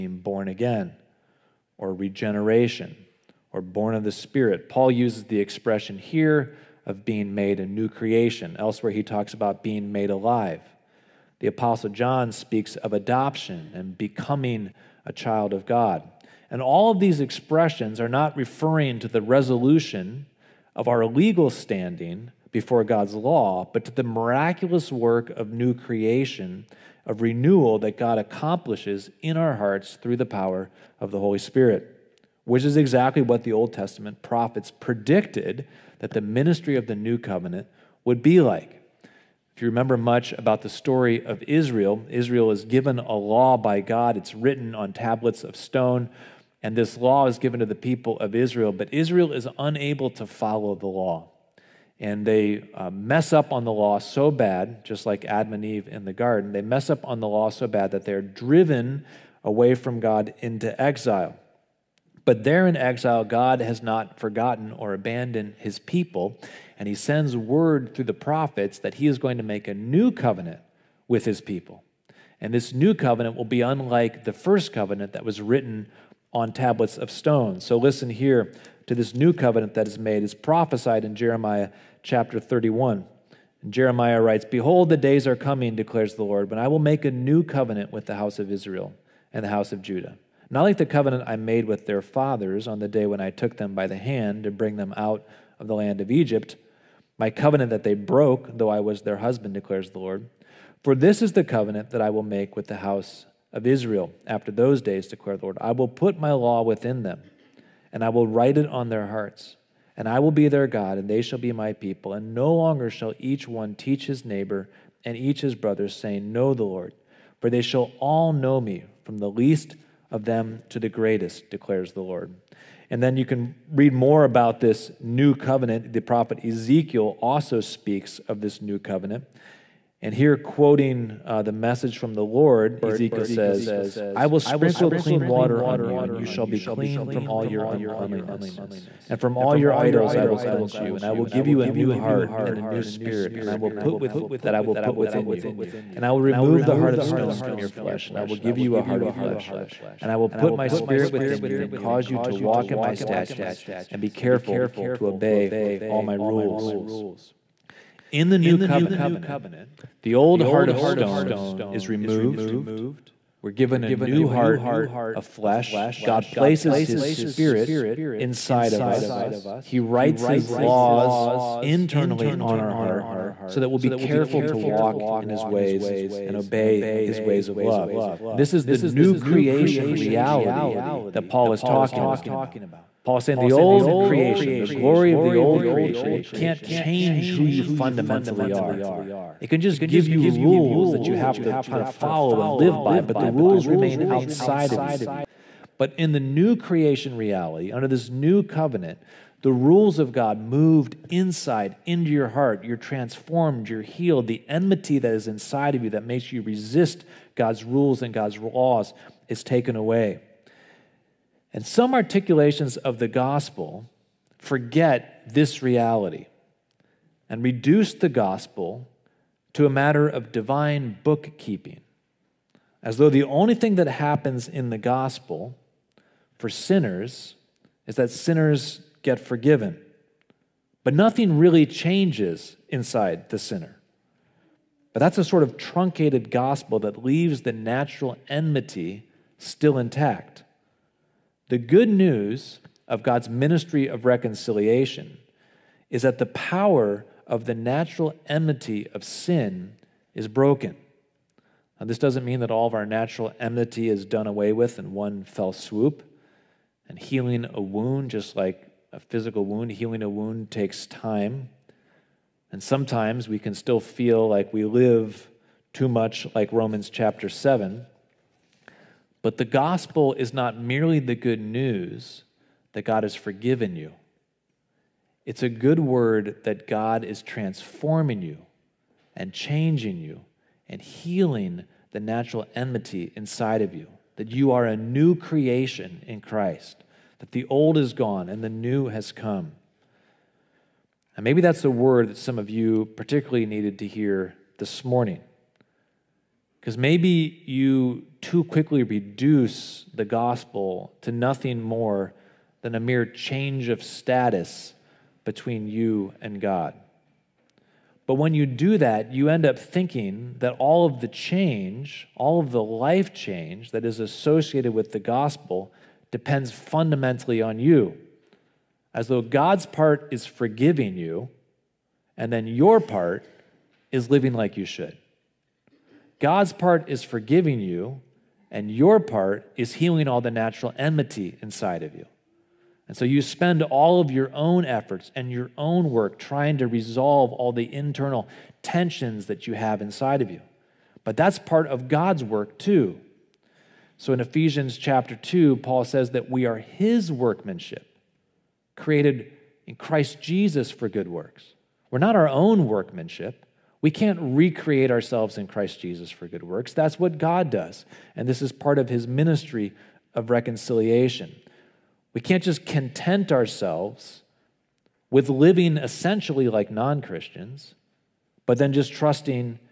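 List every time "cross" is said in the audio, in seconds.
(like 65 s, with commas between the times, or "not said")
not said.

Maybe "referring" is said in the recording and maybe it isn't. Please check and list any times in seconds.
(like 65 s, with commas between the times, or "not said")
18 s.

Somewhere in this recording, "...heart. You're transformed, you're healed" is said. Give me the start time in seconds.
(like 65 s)
202 s.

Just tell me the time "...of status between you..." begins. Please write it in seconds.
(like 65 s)
303 s.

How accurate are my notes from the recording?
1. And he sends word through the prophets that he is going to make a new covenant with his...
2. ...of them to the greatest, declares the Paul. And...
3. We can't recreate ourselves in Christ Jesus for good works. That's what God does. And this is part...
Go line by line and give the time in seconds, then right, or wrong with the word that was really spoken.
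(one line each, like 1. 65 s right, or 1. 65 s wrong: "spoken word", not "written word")
1. 66 s right
2. 120 s wrong: "Lord", not "Paul"
3. 353 s right.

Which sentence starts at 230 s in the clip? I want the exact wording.
But nothing really changes inside the sinner.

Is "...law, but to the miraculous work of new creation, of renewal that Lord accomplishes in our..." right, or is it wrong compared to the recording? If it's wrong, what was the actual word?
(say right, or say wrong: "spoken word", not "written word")
wrong: "God", not "Lord".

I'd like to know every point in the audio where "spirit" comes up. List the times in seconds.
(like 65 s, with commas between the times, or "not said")
4 s, 31 s, 142 s, 150 s, 167 s.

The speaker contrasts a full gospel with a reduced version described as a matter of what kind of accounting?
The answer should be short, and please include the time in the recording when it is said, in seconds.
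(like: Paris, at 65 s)
Divine bookkeeping, at 220 s.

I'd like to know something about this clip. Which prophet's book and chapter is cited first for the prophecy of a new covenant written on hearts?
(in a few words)
Jeremiah 31.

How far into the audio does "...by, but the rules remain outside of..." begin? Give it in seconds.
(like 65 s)
192 s.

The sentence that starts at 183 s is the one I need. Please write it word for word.
Paul is saying the old creation, the glory of the old creation, it can't change who you fundamentally are.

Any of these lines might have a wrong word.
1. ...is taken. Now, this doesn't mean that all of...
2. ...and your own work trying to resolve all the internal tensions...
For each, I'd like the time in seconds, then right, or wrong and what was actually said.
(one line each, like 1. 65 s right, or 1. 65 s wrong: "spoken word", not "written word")
1. 250 s wrong: "broken", not "taken"
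2. 335 s right.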